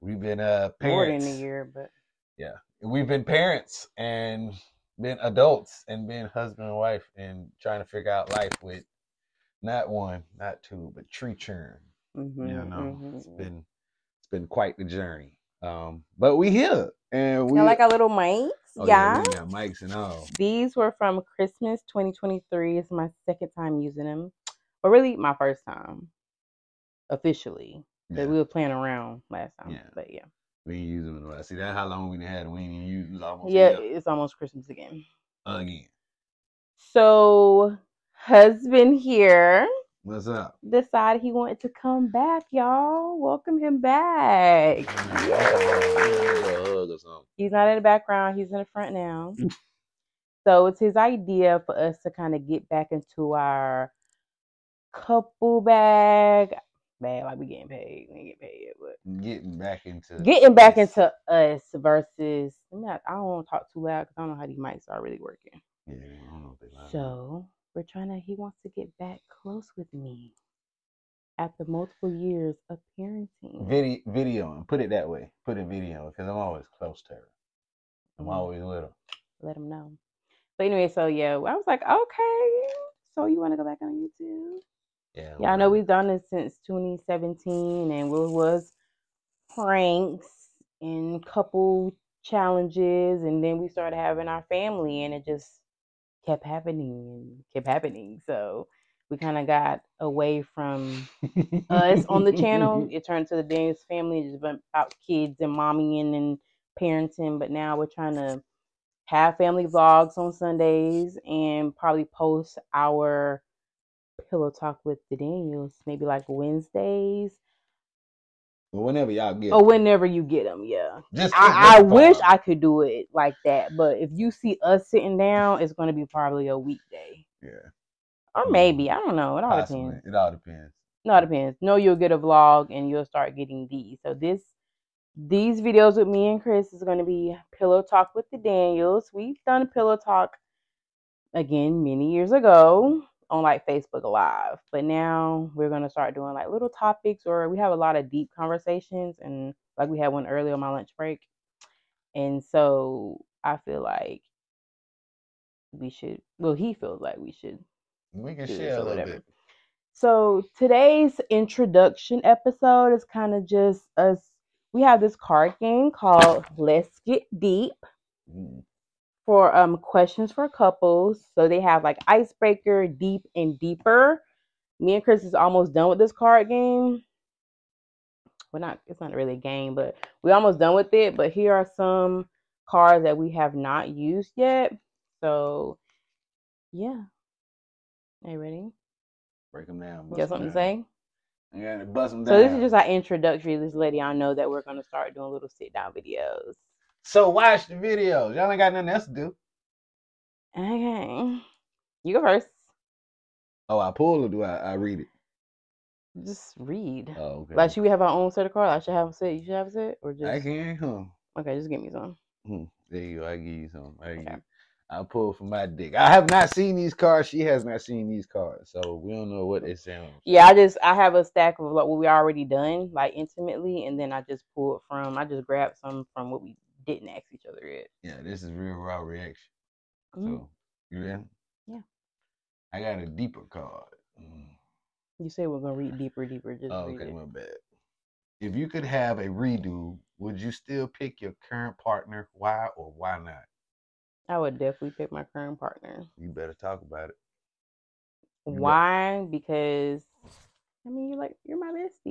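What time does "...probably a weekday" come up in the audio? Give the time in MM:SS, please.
02:06.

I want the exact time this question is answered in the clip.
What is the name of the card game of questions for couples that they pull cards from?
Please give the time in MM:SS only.
02:46.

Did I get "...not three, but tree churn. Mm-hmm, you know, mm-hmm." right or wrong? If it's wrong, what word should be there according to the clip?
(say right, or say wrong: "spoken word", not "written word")
wrong: "two", not "three".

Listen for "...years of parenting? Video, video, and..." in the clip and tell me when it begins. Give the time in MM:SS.
01:12.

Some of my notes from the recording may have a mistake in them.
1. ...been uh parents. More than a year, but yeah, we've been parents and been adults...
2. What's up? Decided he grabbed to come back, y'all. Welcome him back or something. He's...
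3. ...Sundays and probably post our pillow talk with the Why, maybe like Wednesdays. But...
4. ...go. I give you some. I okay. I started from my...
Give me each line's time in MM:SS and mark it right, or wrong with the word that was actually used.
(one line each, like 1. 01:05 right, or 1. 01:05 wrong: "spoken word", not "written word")
1. 00:00 right
2. 00:40 wrong: "wanted", not "grabbed"
3. 01:50 wrong: "Daniels", not "Why"
4. 03:33 wrong: "pulled", not "started".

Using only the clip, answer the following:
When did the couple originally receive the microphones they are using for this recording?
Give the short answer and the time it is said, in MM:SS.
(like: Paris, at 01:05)
Christmas 2023, at 00:21.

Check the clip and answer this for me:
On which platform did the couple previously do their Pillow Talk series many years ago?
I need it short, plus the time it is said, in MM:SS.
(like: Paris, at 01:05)
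Facebook Live, at 02:23.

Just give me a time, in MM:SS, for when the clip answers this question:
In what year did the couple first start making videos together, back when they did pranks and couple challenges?
01:26.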